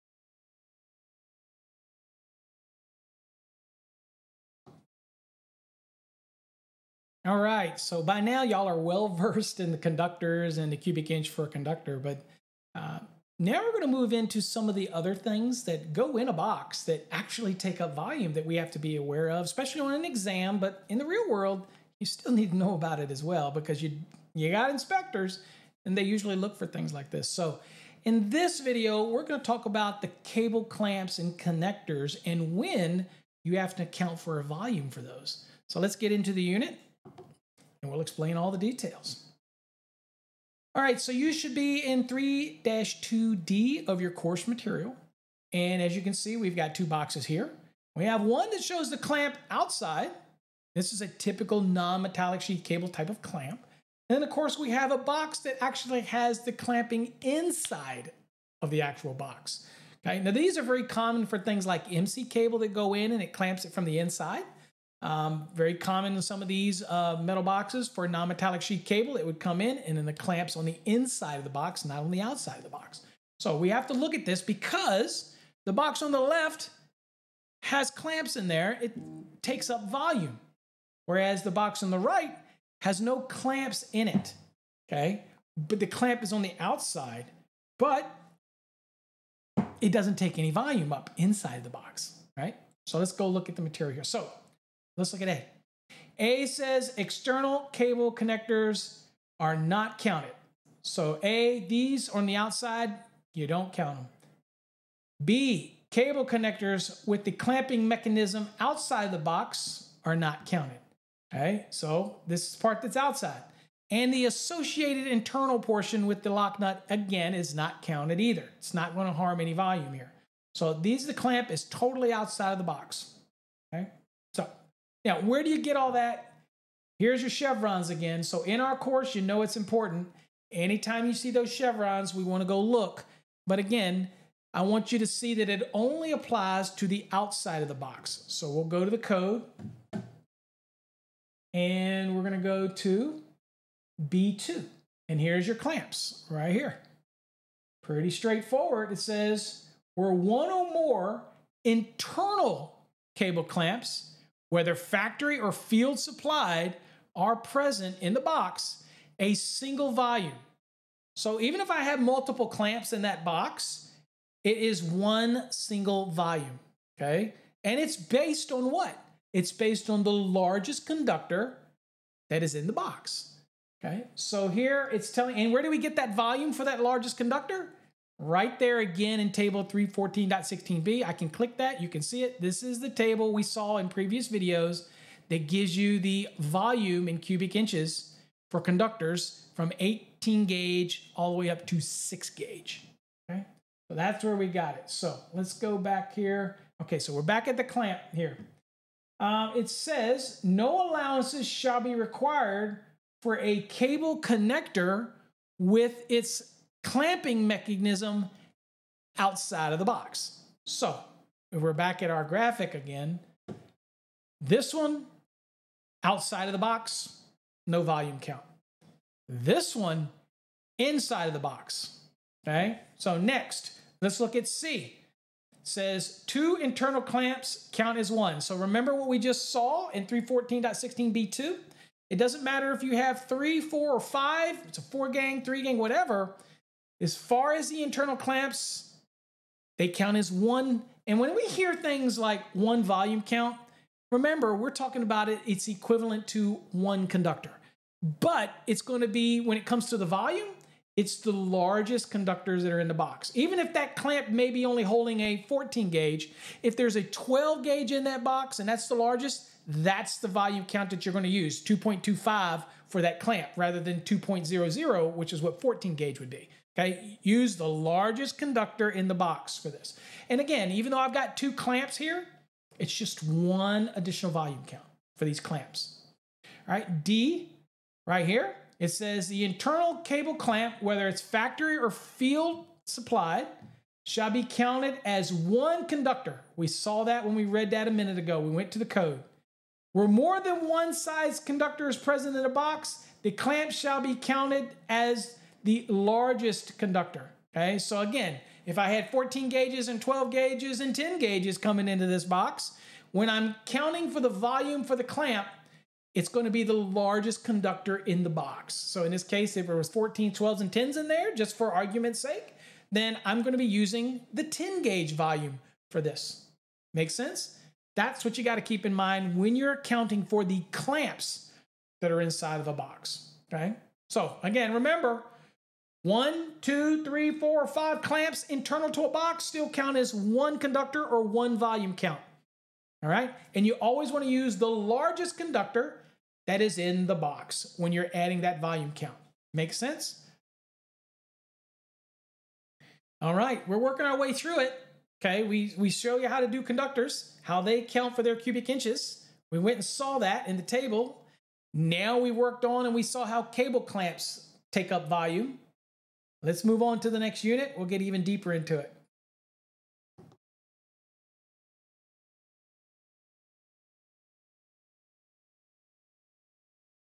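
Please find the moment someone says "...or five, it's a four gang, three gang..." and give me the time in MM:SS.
03:53.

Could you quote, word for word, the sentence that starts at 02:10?
Anytime you see those chevrons, we want to go look.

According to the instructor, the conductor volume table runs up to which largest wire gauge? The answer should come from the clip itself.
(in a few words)
6 gauge.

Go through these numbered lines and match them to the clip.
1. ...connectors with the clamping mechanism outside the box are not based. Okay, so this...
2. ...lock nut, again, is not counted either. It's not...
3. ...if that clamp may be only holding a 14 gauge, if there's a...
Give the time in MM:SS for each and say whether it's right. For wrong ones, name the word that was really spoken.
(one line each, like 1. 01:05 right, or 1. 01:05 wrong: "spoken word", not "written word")
1. 01:46 wrong: "counted", not "based"
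2. 01:56 right
3. 04:13 right.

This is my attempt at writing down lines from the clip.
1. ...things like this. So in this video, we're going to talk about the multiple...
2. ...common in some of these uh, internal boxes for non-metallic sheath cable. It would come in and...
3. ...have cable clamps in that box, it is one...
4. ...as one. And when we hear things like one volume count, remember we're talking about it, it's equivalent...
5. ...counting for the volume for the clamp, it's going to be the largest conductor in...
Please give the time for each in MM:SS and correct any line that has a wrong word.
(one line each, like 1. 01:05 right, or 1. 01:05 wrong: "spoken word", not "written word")
1. 00:26 wrong: "cable", not "multiple"
2. 01:05 wrong: "metal", not "internal"
3. 02:41 wrong: "multiple", not "cable"
4. 04:00 right
5. 05:03 right.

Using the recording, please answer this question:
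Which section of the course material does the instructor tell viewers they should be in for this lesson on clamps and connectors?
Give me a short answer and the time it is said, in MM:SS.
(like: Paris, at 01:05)
3-2D, at 00:42.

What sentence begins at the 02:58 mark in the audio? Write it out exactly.
right there again in table 314.16b.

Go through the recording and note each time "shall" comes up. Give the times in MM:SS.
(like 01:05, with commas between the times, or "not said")
03:21, 04:44, 04:53.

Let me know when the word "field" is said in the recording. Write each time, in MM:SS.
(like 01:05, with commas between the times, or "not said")
02:35, 04:41.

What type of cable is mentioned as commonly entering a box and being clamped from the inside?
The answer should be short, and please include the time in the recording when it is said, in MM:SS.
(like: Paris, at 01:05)
MC cable, at 01:01.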